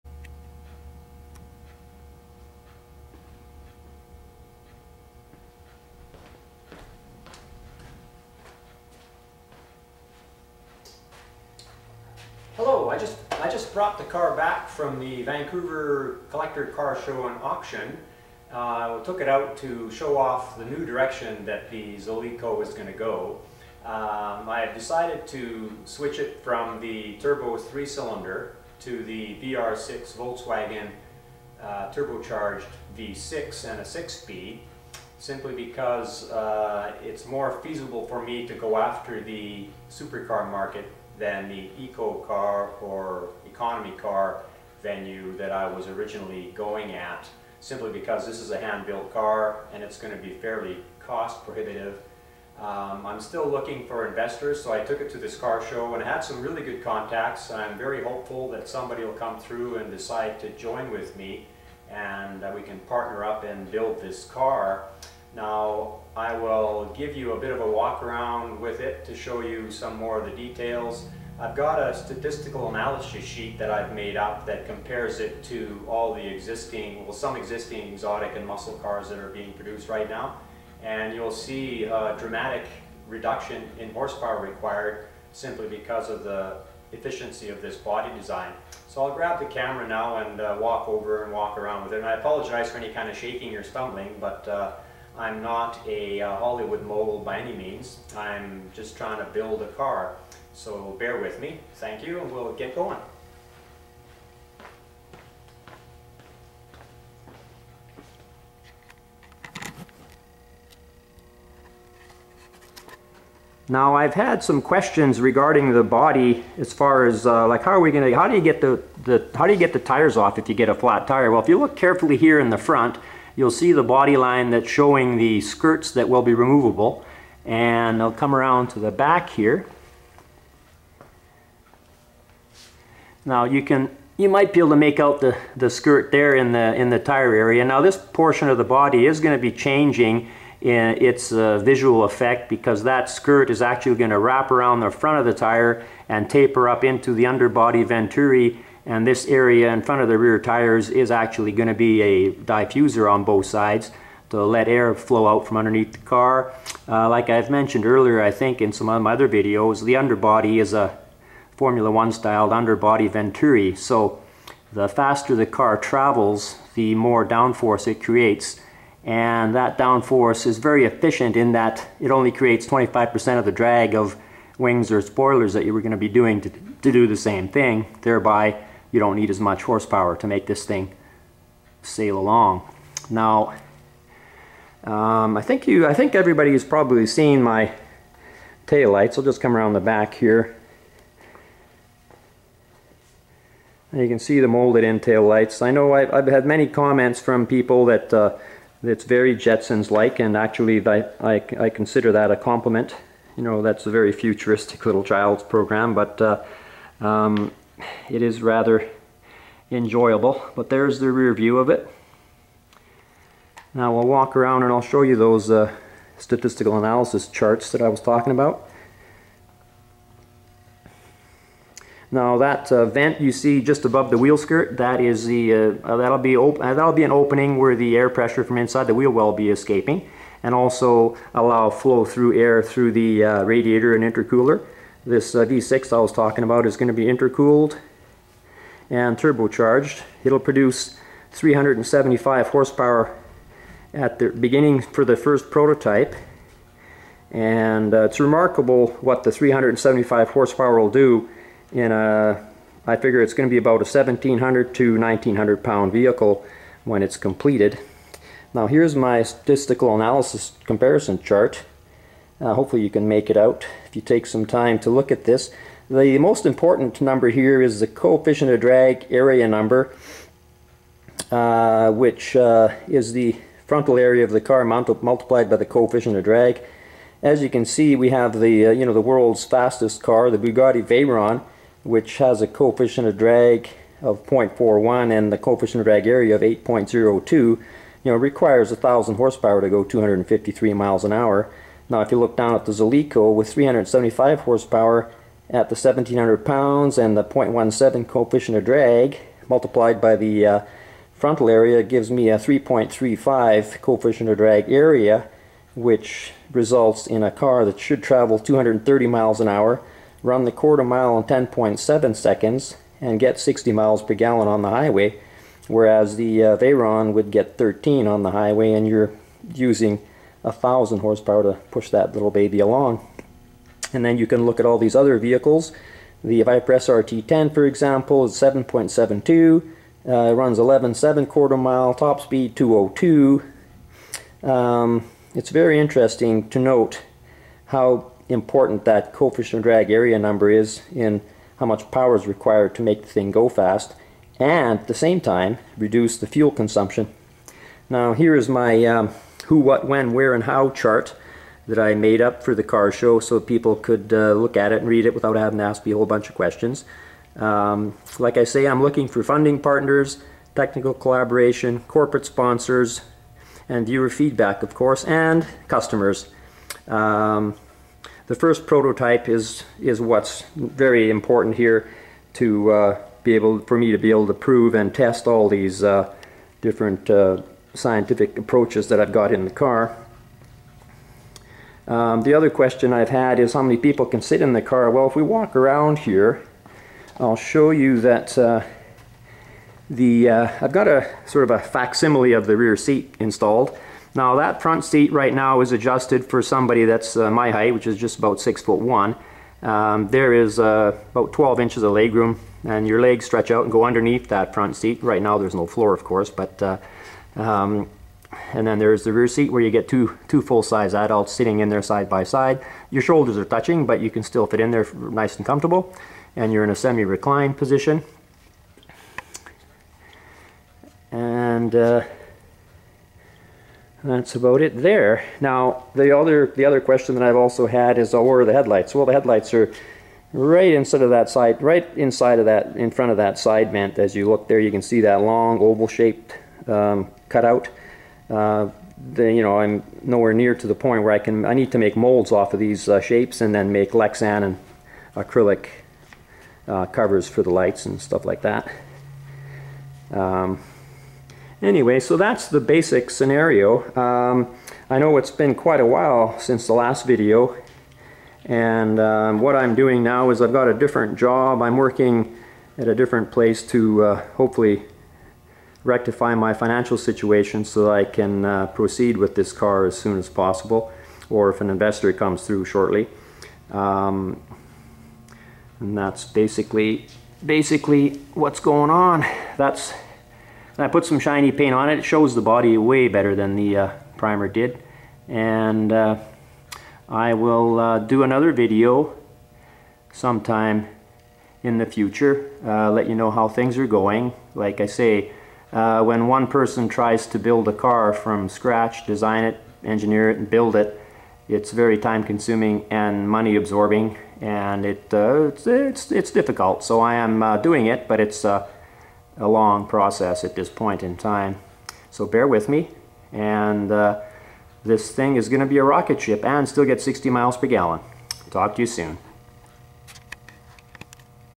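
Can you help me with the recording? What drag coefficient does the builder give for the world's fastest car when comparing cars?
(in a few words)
0.41.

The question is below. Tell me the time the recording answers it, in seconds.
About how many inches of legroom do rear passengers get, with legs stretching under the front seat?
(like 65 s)
401 s.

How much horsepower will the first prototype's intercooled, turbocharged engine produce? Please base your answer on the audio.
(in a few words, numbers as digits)
375.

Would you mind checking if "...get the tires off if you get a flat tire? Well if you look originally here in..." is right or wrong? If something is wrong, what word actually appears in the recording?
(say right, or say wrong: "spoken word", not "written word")
wrong: "carefully", not "originally".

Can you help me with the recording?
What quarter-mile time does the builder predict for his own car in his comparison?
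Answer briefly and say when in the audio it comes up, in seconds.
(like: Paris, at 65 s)
10.7 seconds, at 311 s.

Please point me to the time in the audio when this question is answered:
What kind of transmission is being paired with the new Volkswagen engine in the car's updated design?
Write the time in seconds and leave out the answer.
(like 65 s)
33 s.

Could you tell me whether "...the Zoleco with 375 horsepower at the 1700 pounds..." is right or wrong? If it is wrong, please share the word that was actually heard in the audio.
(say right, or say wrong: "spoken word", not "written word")
right.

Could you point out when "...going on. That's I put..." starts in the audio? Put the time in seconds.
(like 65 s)
478 s.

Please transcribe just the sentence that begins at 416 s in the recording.
And you're in a semi-reclined position.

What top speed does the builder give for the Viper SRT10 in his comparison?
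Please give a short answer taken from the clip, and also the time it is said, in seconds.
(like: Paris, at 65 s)
202, at 331 s.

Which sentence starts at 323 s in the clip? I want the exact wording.
And then you can look at all these other vehicles.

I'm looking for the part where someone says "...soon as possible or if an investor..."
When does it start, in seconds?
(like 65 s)
469 s.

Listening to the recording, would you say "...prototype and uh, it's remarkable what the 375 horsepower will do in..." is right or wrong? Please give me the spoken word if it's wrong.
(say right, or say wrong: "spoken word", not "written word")
right.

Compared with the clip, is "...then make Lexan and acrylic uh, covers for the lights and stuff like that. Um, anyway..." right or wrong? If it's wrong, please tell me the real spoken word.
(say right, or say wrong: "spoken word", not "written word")
right.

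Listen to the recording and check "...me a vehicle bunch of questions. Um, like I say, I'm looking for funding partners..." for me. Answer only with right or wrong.
wrong.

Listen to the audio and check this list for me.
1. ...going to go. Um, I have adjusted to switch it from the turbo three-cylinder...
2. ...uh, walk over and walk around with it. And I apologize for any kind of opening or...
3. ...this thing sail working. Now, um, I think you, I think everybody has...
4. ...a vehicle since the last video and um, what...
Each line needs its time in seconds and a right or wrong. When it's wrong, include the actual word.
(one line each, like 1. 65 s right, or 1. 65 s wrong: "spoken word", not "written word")
1. 22 s wrong: "decided", not "adjusted"
2. 90 s wrong: "shaking", not "opening"
3. 180 s wrong: "along", not "working"
4. 455 s wrong: "while", not "vehicle".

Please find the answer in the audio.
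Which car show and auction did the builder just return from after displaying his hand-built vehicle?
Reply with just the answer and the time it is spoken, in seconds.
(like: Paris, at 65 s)
Vancouver Collector Car Show and Auction, at 15 s.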